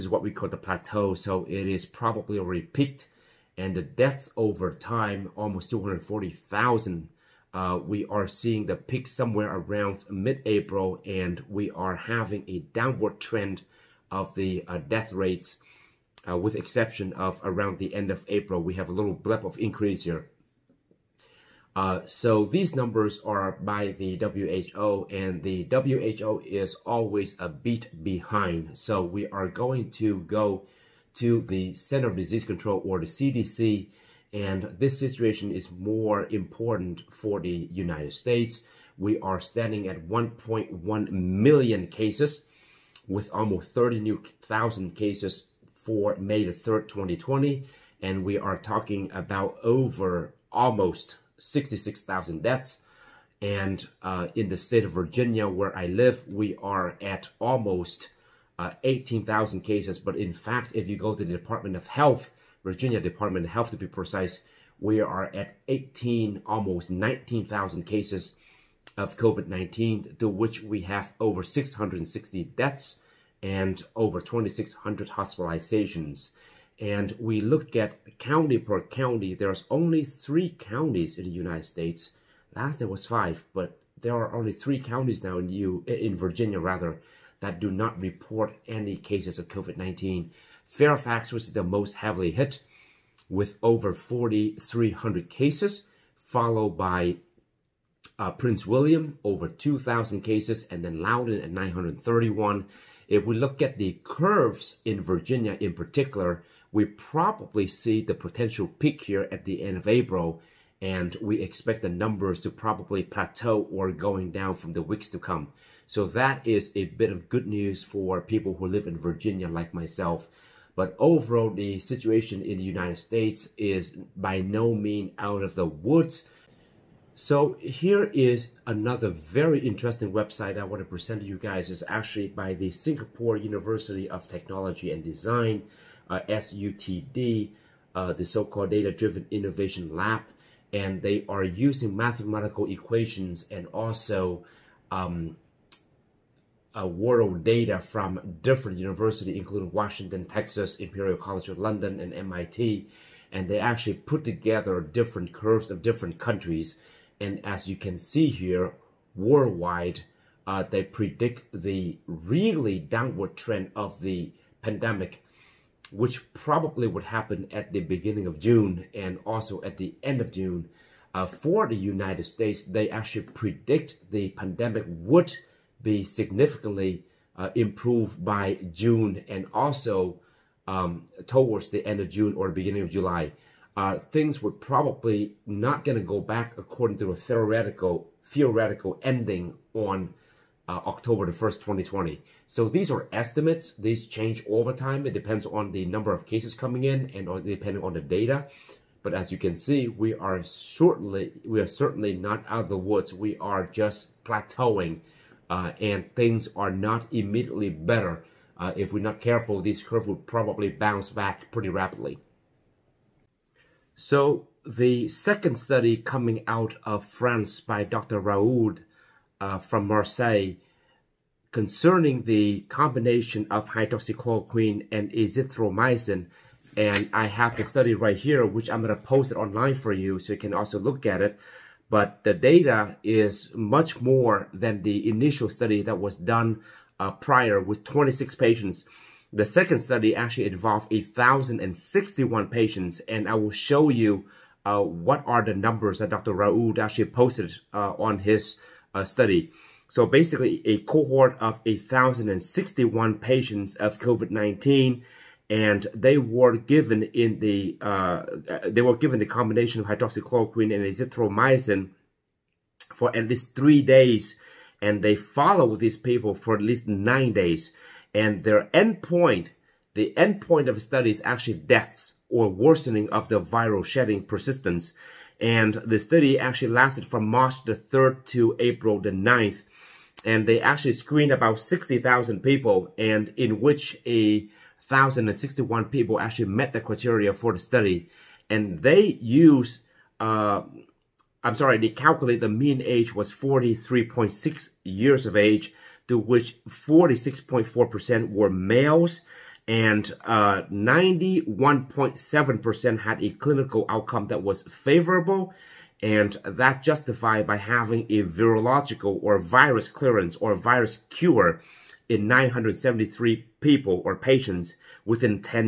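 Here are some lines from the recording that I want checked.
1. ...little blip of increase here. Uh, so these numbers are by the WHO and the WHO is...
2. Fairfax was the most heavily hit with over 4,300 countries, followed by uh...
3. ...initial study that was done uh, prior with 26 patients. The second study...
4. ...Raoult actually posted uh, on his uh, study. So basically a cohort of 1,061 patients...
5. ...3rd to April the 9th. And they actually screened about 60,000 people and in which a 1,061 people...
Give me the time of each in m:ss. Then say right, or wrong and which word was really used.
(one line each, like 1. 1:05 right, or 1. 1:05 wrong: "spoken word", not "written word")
1. 0:18 right
2. 1:30 wrong: "cases", not "countries"
3. 3:55 right
4. 4:06 right
5. 4:37 right.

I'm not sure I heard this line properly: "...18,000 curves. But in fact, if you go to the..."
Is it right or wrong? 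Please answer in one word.
wrong.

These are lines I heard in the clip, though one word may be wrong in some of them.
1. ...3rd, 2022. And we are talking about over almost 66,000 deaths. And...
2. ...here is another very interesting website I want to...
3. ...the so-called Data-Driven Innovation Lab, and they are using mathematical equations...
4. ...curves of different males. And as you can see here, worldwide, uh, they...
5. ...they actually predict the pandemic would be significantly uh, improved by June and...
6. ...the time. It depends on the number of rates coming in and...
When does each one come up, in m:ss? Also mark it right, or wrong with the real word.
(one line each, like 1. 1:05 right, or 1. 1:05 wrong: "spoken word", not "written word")
1. 0:46 wrong: "2020", not "2022"
2. 2:07 right
3. 2:18 right
4. 2:35 wrong: "countries", not "males"
5. 2:52 right
6. 3:14 wrong: "cases", not "rates".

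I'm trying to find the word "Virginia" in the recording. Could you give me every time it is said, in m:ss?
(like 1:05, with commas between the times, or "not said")
0:54, 1:02, 1:26, 1:45, 1:58.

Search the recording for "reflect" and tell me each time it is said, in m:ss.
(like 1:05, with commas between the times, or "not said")
not said.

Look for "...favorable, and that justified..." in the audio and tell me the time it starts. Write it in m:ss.
5:04.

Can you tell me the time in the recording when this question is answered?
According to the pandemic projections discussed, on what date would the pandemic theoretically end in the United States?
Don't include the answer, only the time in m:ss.
3:10.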